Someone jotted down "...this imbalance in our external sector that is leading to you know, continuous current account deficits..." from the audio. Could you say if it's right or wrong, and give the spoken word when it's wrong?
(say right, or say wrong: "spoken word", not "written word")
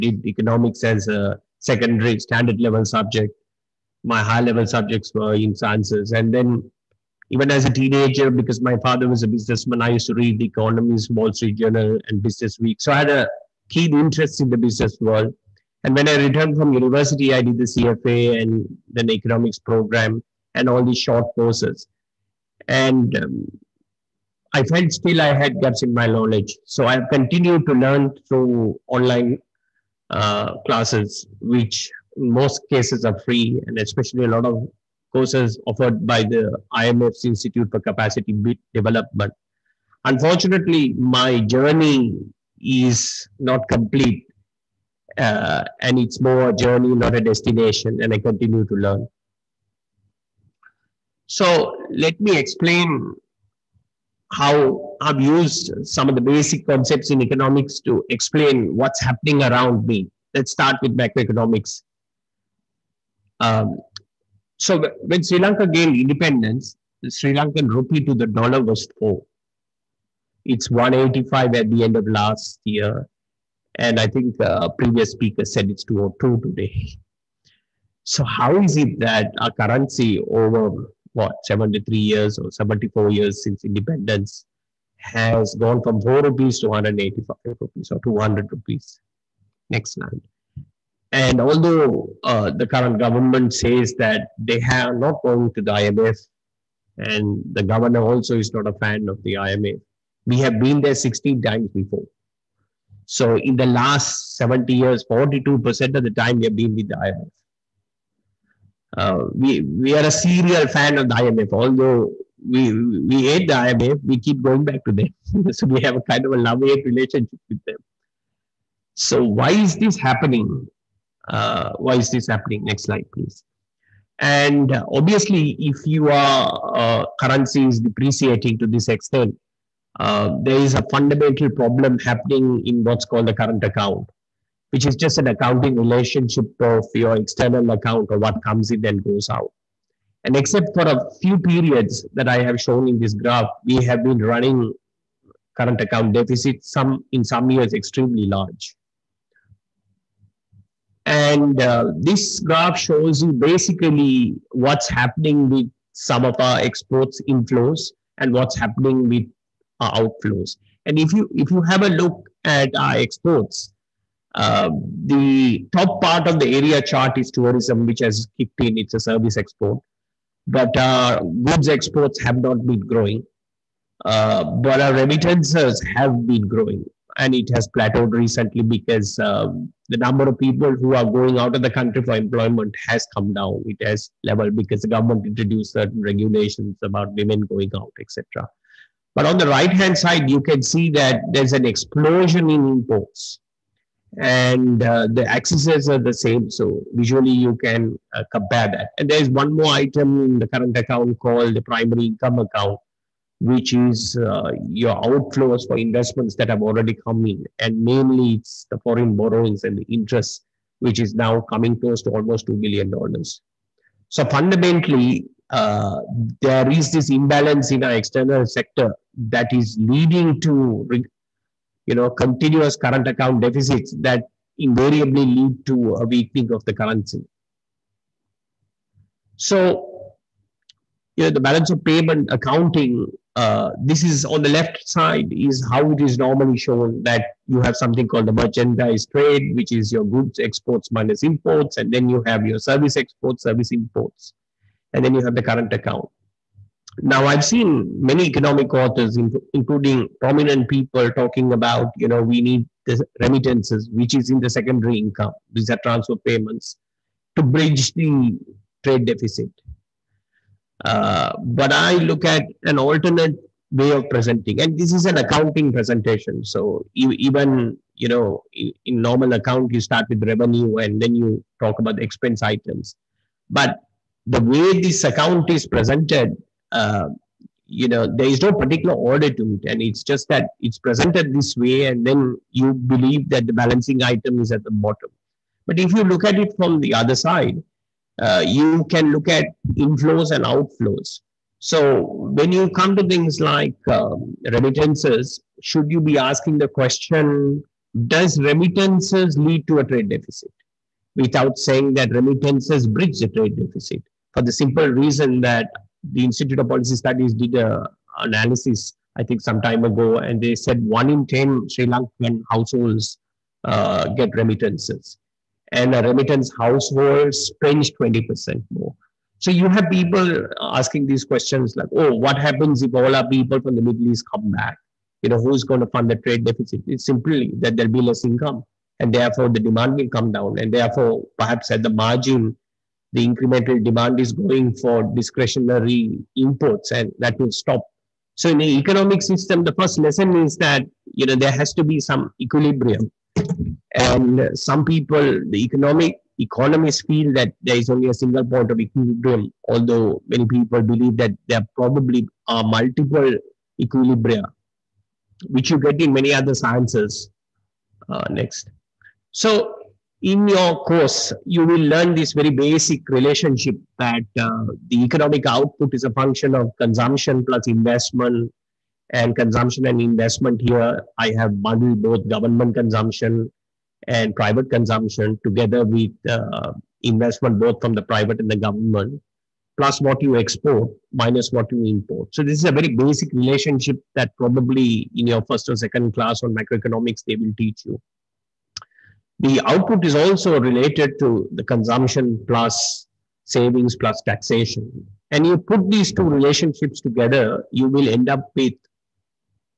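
right.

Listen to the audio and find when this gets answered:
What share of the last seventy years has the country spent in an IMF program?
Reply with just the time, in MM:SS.
01:45.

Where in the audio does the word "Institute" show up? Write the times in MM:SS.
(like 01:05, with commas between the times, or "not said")
00:37, 05:06.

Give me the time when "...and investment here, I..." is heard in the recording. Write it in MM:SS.
06:09.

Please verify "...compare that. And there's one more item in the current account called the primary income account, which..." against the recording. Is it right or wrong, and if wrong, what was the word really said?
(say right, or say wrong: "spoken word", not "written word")
right.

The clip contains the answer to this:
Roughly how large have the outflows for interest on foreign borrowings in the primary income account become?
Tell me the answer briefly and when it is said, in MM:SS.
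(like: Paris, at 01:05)
$2 billion, at 03:32.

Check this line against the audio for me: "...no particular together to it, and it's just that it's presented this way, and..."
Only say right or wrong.
wrong.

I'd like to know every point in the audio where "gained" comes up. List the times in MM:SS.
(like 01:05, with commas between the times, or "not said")
01:05.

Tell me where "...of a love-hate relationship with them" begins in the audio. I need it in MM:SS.
01:56.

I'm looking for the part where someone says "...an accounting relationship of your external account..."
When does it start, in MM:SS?
02:15.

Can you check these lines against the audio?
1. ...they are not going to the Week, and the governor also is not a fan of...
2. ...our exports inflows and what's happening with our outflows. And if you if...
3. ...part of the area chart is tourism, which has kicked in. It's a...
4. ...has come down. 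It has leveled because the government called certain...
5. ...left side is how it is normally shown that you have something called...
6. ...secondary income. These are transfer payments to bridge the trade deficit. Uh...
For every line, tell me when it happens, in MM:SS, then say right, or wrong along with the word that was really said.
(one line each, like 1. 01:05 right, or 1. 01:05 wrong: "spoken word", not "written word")
1. 01:34 wrong: "IMF", not "Week"
2. 02:36 right
3. 02:46 right
4. 03:02 wrong: "introduced", not "called"
5. 03:54 right
6. 04:14 right.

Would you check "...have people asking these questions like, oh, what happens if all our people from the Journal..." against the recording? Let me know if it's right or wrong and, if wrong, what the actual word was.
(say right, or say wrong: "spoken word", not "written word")
wrong: "Middle", not "Journal".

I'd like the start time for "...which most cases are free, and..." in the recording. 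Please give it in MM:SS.
00:31.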